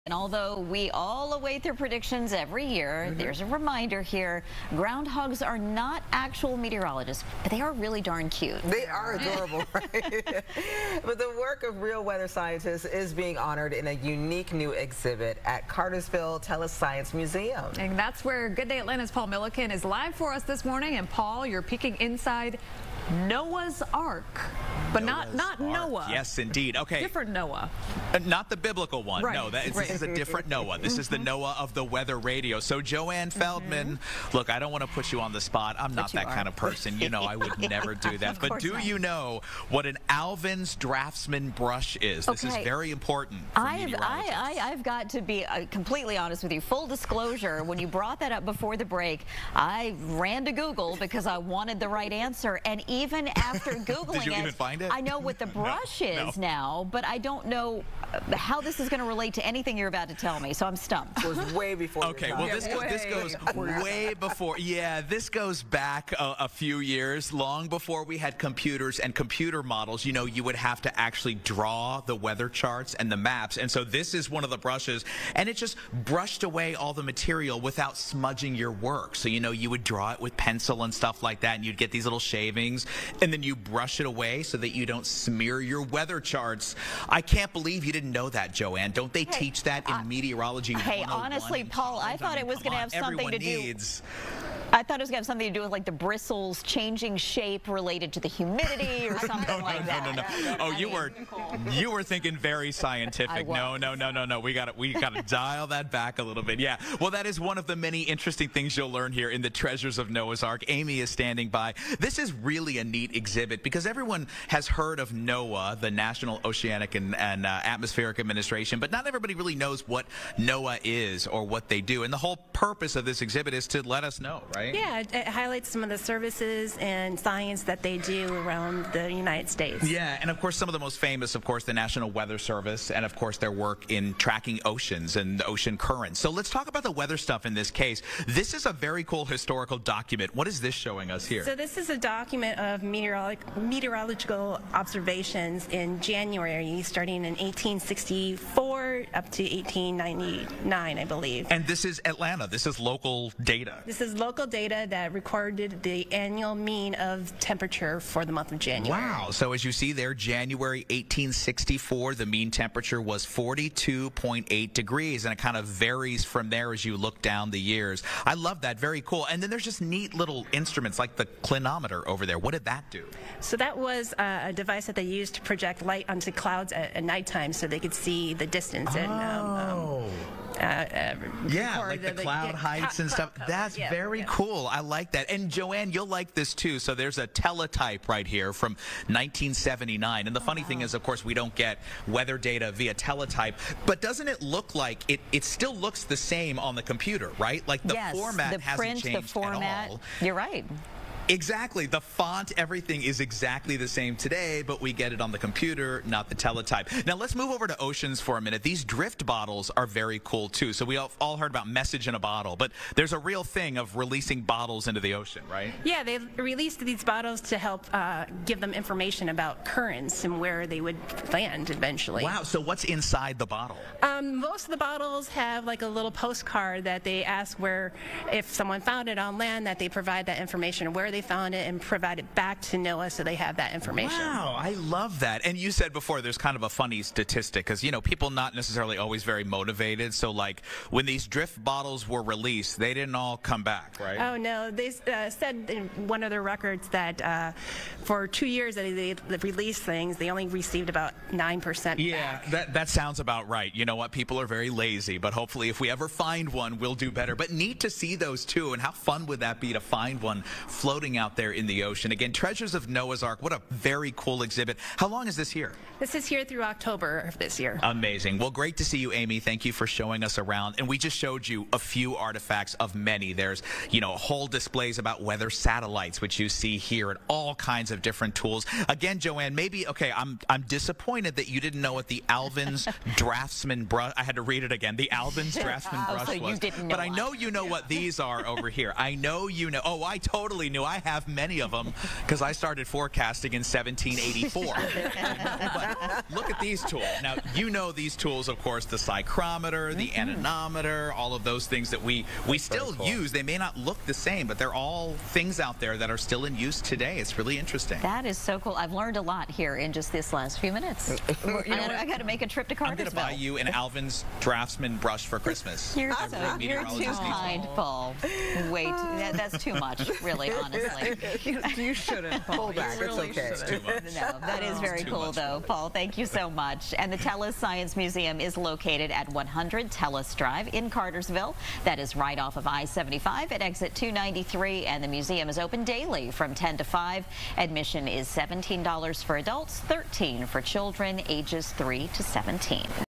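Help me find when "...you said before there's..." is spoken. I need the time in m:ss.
3:55.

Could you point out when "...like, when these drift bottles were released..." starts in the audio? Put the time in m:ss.
4:00.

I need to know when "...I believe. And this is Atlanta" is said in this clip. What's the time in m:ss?
2:30.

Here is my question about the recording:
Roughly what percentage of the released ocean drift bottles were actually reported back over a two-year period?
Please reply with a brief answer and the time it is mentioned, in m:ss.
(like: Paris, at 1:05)
9%, at 4:11.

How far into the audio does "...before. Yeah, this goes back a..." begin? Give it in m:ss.
1:04.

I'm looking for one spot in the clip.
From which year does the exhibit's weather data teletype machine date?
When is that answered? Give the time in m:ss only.
3:09.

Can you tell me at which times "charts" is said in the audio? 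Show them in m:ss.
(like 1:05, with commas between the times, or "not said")
1:12, 1:26.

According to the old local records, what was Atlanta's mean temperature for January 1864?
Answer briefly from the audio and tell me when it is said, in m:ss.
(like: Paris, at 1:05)
42.8 degrees, at 2:43.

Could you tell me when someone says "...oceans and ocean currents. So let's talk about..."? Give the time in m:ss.
2:14.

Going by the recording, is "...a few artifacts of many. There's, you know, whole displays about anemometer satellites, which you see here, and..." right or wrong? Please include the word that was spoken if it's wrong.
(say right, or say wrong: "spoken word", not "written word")
wrong: "weather", not "anemometer".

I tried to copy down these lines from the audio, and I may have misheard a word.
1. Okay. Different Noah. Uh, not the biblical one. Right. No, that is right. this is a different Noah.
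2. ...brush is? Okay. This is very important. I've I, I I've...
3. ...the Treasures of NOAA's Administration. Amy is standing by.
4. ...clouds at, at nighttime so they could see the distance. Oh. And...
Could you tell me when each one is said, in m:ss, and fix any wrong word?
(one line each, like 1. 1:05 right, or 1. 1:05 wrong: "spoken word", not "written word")
1. 0:26 right
2. 0:41 right
3. 1:49 wrong: "Ark", not "Administration"
4. 2:56 right.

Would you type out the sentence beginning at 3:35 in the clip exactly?
Yeah, they released these bottles to help uh, give them information about currents and where they would land eventually.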